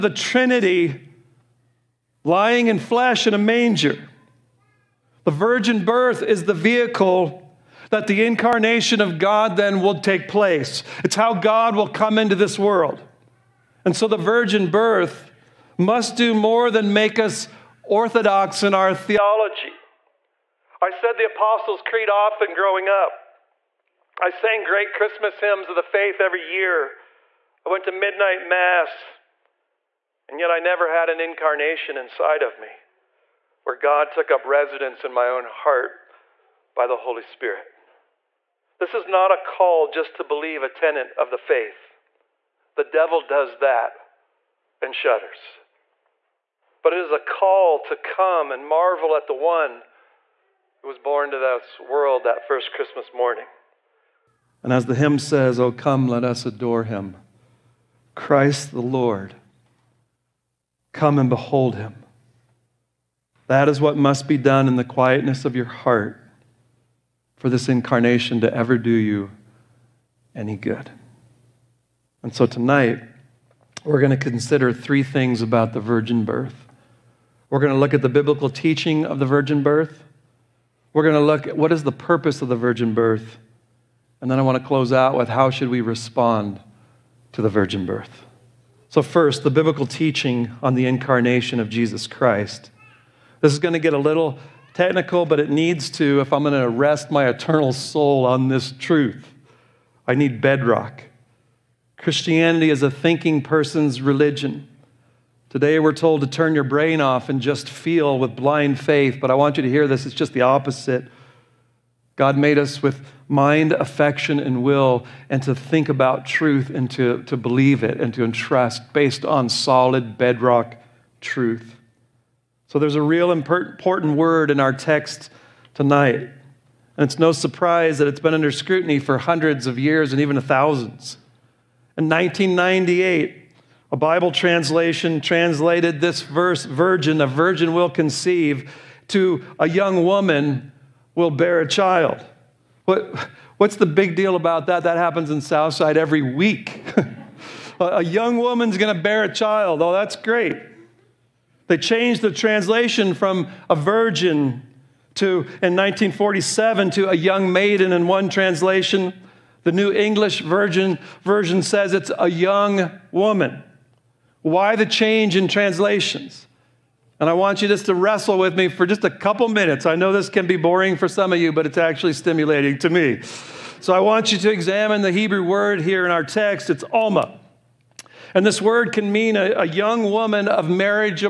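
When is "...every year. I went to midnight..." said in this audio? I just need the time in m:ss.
0:26.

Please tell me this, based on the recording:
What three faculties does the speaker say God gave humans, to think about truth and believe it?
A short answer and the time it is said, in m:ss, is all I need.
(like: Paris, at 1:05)
Mind, affection, and will, at 1:53.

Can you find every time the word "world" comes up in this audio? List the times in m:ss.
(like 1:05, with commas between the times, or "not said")
0:12, 0:51.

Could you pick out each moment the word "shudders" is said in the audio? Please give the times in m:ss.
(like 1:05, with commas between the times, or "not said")
0:44.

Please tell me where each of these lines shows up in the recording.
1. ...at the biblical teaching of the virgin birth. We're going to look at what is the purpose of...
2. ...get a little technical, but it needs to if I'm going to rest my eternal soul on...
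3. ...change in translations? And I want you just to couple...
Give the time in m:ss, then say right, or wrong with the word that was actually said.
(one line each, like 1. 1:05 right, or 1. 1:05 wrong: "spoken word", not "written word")
1. 1:17 right
2. 1:33 right
3. 2:44 wrong: "wrestle", not "couple".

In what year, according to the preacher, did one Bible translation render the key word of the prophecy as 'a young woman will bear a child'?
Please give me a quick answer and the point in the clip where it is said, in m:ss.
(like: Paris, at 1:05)
1998, at 2:12.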